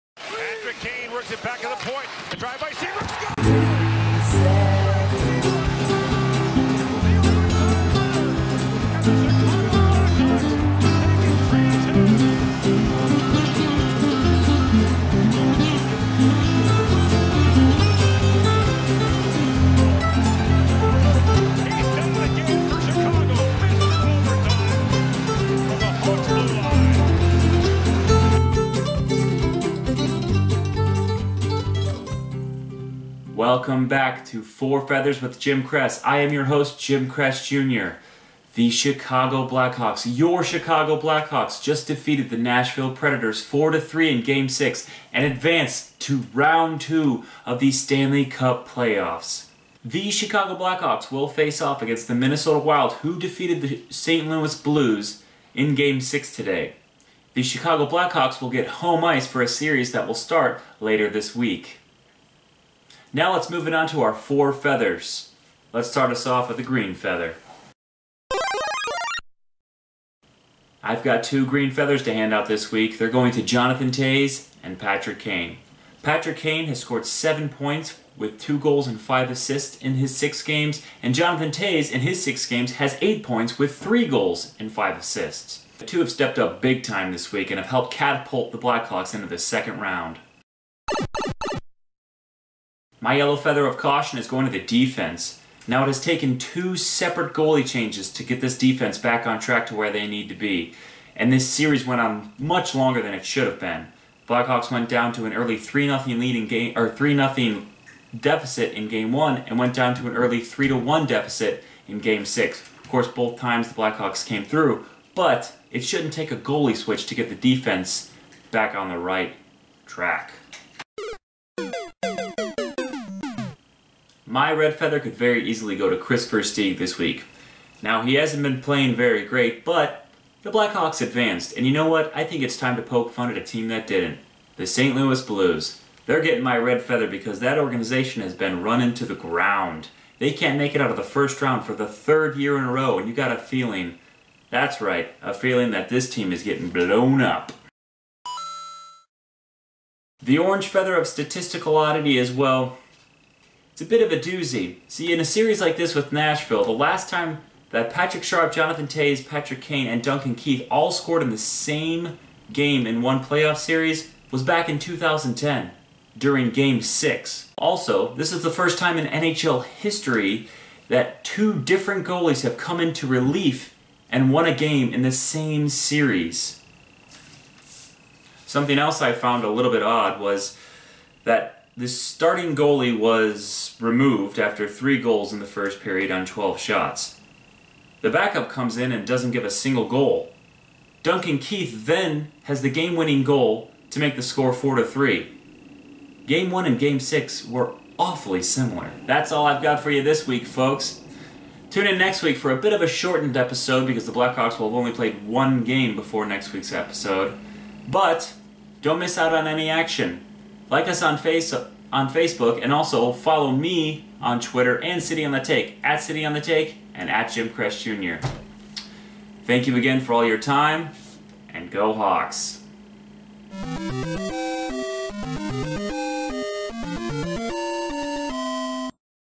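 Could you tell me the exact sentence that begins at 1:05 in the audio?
Let's start us off with a green feather.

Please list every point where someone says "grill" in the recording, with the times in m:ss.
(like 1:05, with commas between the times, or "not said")
not said.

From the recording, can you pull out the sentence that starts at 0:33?
Welcome back to Four Feathers with Jim Krees.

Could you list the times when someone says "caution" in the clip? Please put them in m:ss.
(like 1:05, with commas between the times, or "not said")
1:33.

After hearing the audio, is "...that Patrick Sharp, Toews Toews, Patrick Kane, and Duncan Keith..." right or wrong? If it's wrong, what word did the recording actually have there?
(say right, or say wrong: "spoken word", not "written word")
wrong: "Jonathan", not "Toews".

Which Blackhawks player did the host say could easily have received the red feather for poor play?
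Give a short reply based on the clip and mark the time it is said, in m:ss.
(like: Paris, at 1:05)
Kris Versteeg, at 2:05.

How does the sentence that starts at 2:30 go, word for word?
The orange feather of statistical oddity is, well, it's a bit of a doozy.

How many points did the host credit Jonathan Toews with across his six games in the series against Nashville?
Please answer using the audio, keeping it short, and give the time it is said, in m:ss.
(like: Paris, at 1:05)
8, at 1:23.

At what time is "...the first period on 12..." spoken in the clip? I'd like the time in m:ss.
3:05.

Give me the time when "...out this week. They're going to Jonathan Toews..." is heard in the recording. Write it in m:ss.
1:12.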